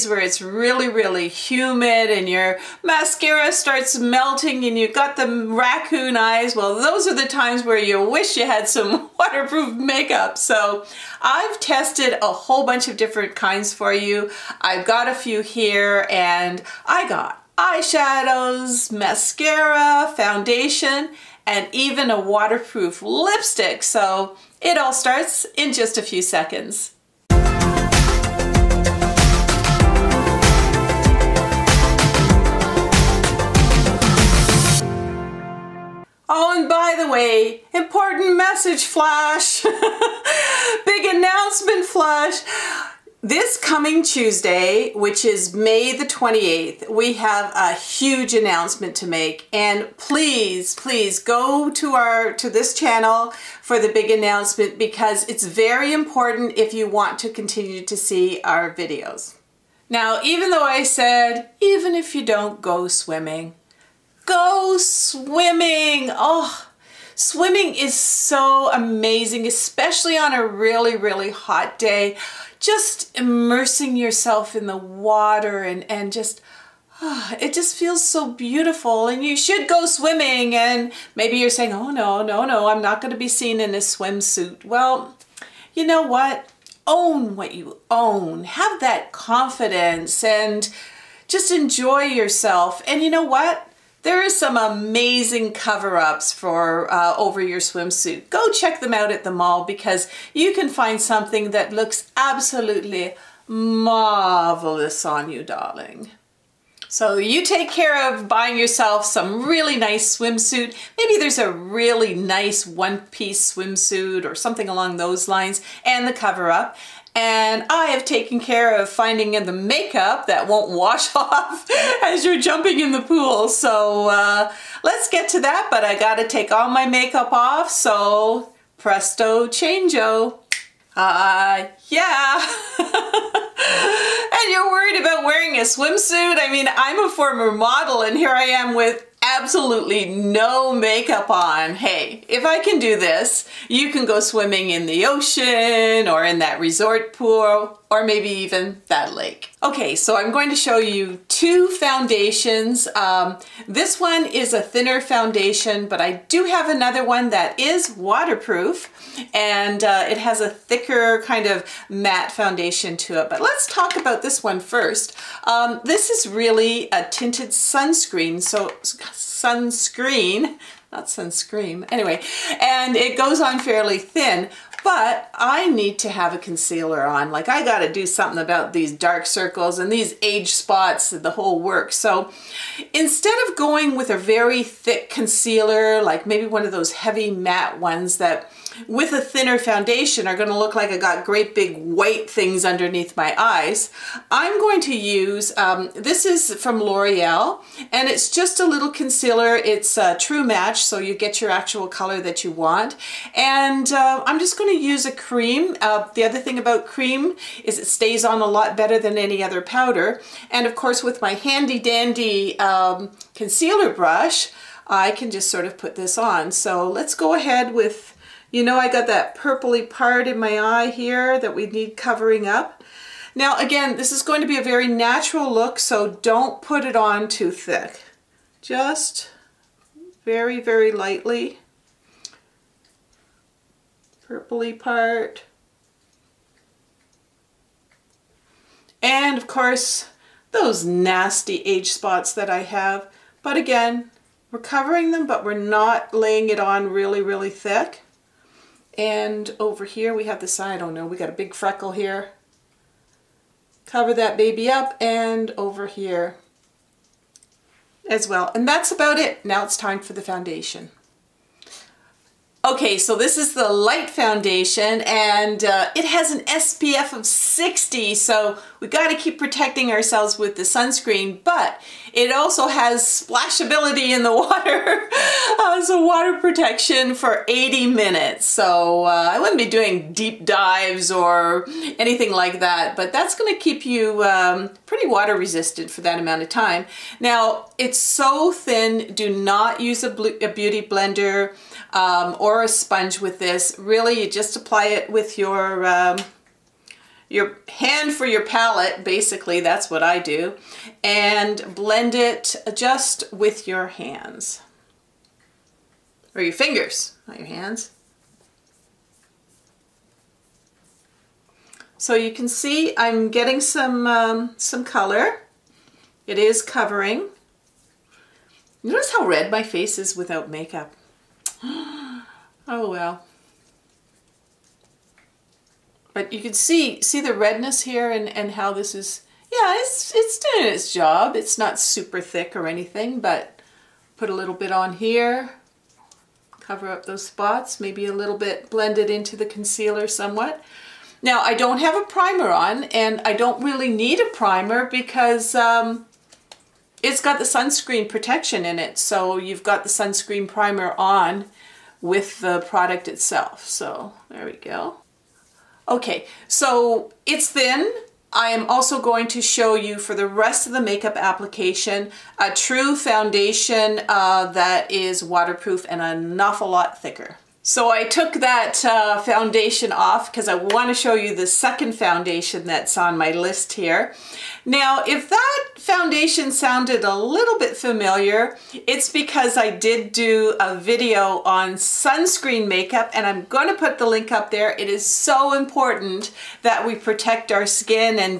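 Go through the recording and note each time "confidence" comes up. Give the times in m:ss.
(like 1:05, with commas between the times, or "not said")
1:29.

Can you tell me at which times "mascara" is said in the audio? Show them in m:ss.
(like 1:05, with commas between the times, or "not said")
0:02, 0:18.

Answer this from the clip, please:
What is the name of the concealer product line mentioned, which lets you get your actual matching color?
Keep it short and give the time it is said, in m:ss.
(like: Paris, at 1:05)
True Match, at 3:20.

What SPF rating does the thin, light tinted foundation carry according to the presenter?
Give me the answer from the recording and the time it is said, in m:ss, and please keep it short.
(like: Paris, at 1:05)
60, at 4:26.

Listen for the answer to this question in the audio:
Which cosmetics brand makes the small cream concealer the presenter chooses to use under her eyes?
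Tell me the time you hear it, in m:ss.
3:16.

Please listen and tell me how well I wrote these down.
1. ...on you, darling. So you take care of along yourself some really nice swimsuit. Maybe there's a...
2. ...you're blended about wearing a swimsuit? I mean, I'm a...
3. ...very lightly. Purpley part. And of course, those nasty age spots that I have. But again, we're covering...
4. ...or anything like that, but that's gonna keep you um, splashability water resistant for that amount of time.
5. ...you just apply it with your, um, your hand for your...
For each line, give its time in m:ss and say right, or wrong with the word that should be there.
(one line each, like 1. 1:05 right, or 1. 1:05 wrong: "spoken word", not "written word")
1. 1:45 wrong: "buying", not "along"
2. 2:14 wrong: "worried", not "blended"
3. 3:50 right
4. 4:41 wrong: "pretty", not "splashability"
5. 4:54 right.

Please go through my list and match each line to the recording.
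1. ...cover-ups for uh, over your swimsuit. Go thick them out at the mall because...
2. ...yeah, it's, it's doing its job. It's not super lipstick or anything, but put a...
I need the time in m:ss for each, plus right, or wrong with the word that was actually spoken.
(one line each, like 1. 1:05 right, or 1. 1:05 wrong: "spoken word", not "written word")
1. 1:35 wrong: "check", not "thick"
2. 5:29 wrong: "thick", not "lipstick".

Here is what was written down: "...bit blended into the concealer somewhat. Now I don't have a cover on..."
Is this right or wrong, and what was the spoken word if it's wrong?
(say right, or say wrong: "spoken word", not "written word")
wrong: "primer", not "cover".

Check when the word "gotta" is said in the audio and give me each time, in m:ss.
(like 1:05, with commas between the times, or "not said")
2:05, 2:57, 4:28.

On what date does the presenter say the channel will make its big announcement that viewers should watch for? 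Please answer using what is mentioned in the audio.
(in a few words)
May 28th.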